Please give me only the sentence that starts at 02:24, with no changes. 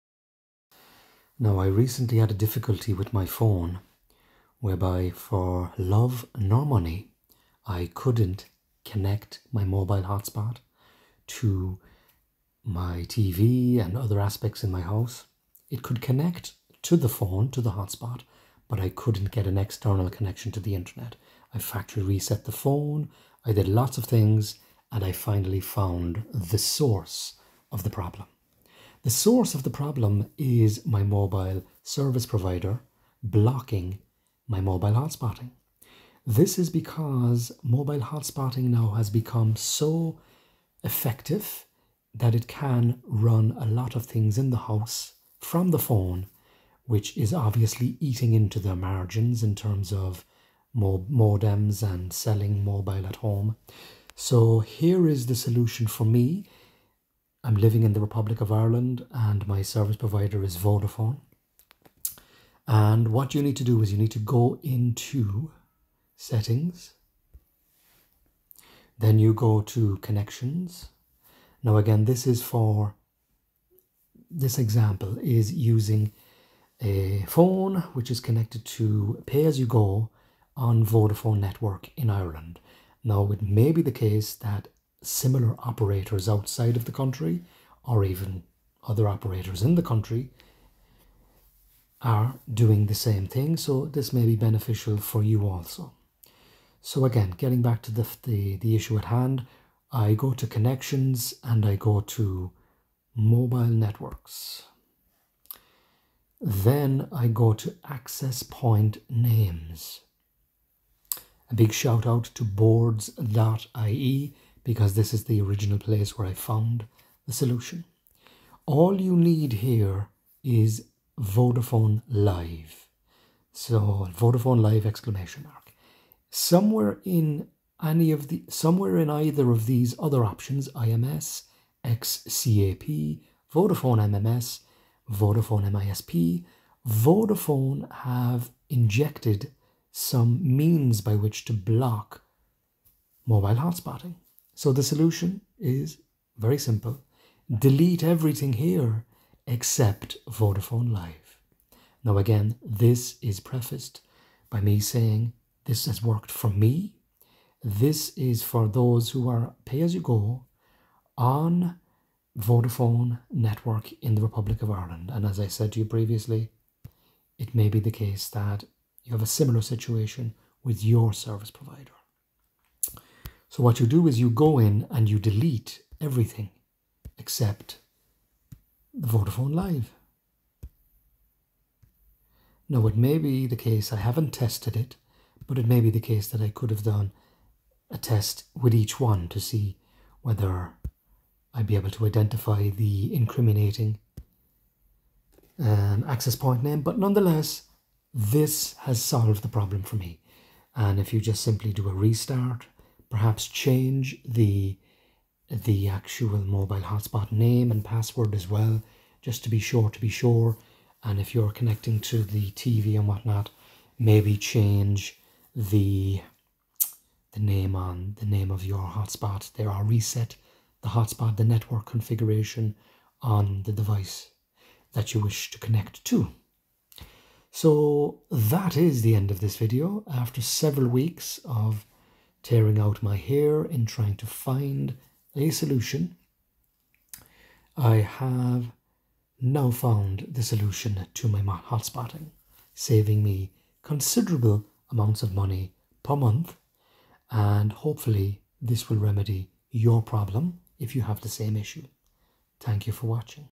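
So the solution is very simple.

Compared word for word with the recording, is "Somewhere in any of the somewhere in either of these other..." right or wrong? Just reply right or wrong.
right.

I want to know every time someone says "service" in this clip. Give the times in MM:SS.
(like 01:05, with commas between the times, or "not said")
00:31, 00:59, 02:51.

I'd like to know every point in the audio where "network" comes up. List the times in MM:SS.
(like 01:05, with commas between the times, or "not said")
01:21, 01:43, 02:43, 03:41.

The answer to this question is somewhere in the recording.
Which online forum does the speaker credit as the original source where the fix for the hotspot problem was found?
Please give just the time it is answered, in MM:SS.
01:52.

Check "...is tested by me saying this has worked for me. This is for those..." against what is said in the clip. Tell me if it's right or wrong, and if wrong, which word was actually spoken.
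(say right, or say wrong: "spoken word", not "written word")
wrong: "prefaced", not "tested".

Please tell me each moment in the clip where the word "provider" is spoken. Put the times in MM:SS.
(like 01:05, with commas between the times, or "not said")
00:32, 00:59, 02:51.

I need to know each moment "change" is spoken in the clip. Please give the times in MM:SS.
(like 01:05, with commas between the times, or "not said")
03:23, 03:34.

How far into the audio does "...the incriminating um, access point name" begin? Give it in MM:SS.
03:12.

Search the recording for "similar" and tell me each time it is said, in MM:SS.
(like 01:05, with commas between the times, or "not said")
01:25, 02:49.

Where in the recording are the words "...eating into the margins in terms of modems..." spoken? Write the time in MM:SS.
00:47.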